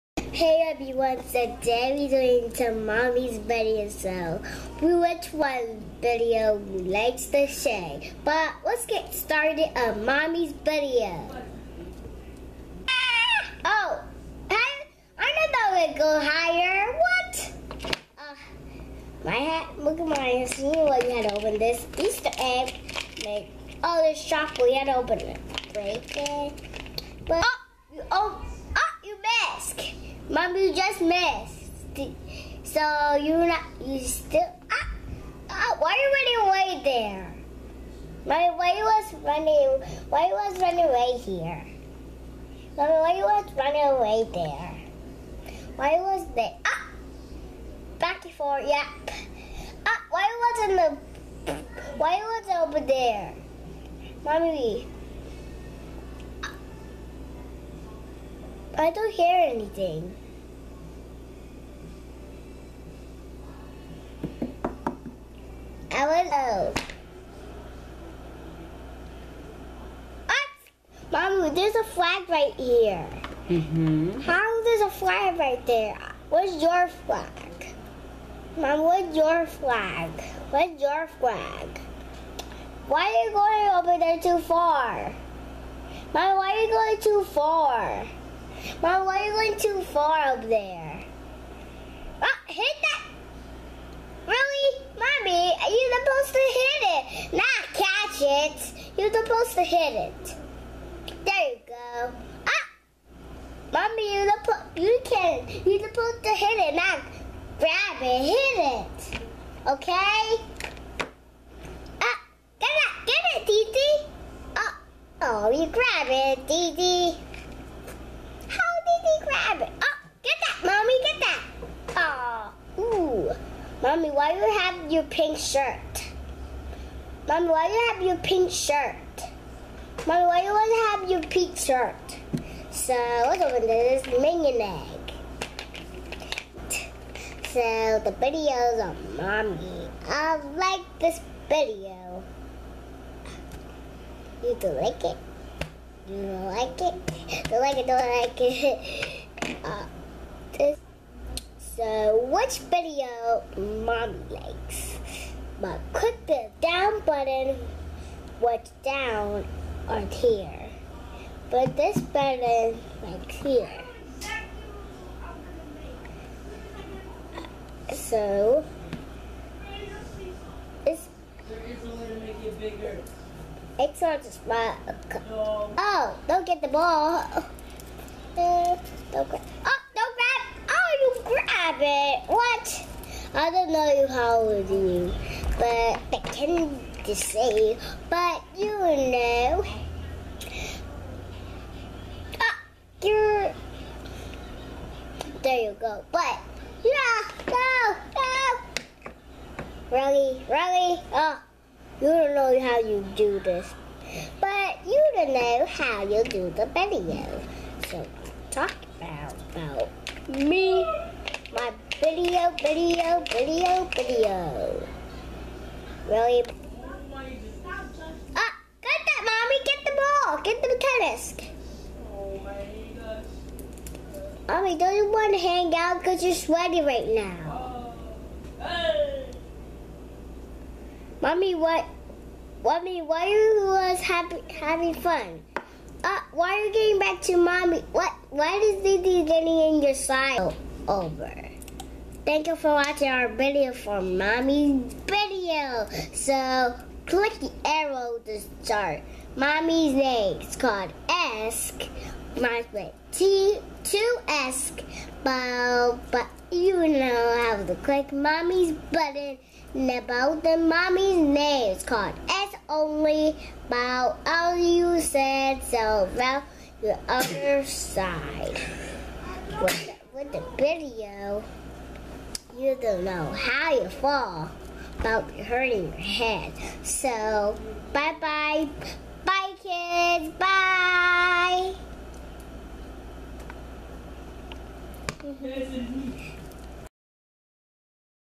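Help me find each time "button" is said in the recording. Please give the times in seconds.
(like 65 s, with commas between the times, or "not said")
157 s, 161 s, 258 s.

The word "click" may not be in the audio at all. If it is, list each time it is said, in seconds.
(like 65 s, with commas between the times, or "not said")
155 s, 247 s, 257 s.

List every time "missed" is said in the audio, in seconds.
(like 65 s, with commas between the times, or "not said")
31 s.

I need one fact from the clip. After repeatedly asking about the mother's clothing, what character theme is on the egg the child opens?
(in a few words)
Minion.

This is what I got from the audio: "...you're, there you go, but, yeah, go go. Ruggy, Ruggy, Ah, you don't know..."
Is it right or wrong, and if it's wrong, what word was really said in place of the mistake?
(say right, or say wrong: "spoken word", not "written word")
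right.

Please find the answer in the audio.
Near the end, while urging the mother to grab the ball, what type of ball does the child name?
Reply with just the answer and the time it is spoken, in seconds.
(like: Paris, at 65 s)
tennis, at 220 s.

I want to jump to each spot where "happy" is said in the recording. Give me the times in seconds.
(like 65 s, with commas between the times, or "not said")
234 s.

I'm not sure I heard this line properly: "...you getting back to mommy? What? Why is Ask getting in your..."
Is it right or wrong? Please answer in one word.
wrong.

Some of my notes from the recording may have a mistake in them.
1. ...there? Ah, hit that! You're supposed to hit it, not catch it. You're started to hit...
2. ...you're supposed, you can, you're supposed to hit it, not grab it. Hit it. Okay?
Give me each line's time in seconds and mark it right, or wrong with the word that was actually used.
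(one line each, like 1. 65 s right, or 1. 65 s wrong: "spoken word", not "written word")
1. 90 s wrong: "supposed", not "started"
2. 104 s right.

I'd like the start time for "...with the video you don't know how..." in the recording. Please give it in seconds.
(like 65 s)
270 s.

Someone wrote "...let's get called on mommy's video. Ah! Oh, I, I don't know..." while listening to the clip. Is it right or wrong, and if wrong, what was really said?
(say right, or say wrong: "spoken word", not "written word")
wrong: "started", not "called".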